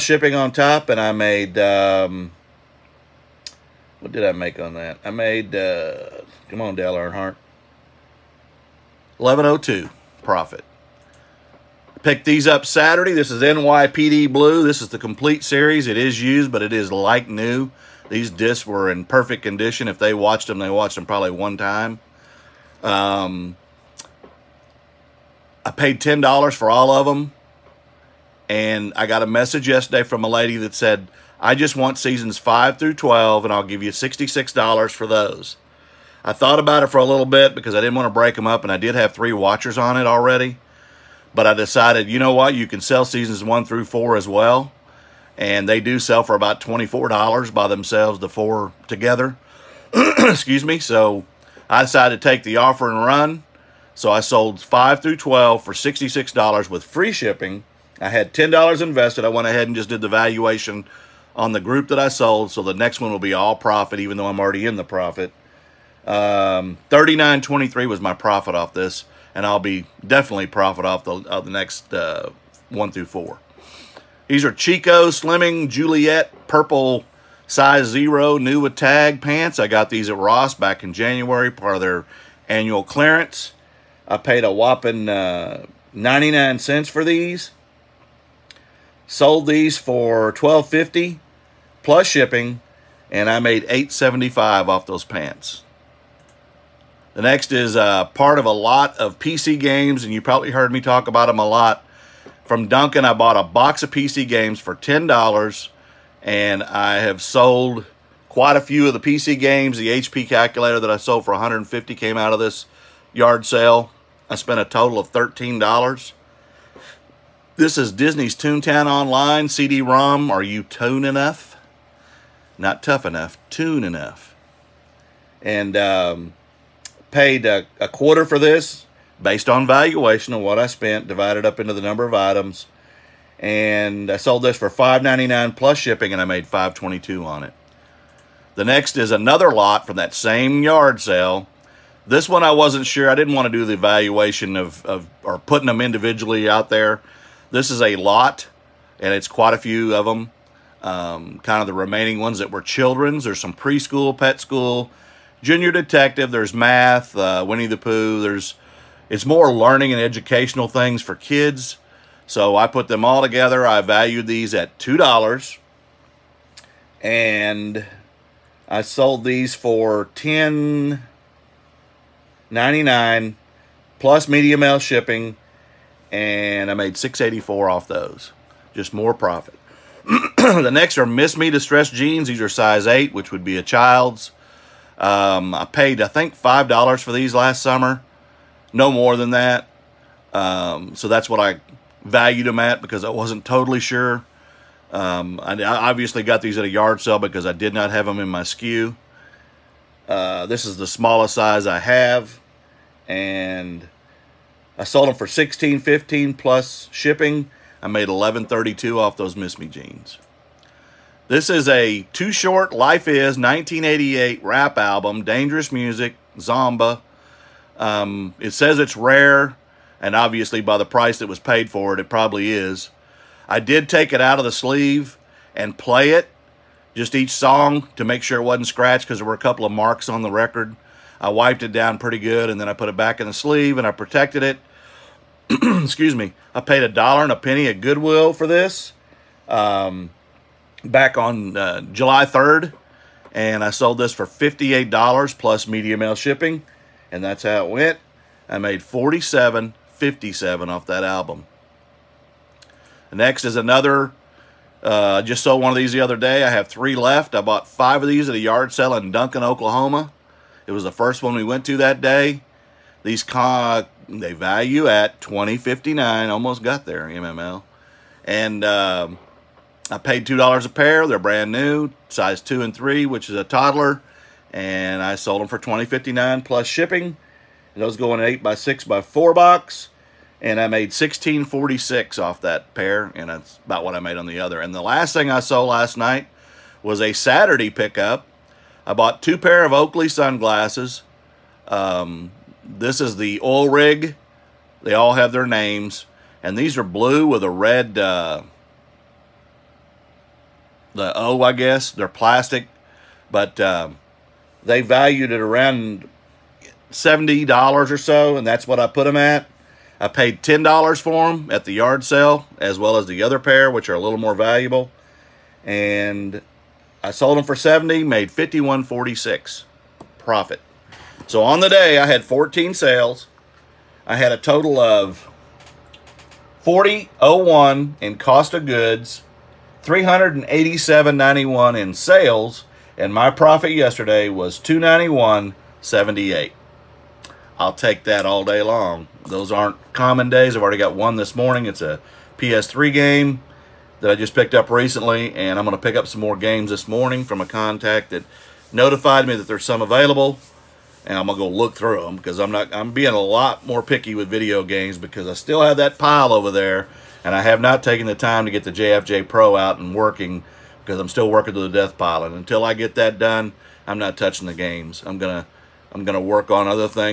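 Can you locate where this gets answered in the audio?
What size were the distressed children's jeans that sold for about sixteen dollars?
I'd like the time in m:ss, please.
3:02.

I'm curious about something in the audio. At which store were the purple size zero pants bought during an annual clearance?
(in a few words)
Ross.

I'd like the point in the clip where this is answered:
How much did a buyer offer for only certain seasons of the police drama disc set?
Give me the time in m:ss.
0:33.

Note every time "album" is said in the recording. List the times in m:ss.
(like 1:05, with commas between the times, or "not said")
3:34, 4:11.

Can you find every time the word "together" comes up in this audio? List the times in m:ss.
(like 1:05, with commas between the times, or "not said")
0:48, 2:43.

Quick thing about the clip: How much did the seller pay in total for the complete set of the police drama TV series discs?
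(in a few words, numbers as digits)
$10.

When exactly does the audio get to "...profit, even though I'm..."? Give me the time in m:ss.
1:03.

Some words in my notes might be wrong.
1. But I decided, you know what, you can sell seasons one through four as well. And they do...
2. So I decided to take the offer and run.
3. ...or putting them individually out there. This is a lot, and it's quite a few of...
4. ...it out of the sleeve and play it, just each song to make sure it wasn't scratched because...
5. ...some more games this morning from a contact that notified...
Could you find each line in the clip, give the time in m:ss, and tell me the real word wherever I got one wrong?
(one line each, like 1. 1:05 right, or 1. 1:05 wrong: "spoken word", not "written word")
1. 0:41 right
2. 0:50 right
3. 2:25 right
4. 3:44 right
5. 5:46 right.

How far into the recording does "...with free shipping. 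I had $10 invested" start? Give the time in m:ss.
0:56.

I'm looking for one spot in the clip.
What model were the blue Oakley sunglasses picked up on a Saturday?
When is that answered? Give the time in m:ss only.
4:52.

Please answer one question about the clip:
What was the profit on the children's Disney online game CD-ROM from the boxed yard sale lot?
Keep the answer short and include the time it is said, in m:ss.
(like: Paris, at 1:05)
$5.22, at 2:16.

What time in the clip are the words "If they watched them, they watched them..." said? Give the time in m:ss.
0:19.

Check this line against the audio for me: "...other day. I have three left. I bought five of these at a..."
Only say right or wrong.
right.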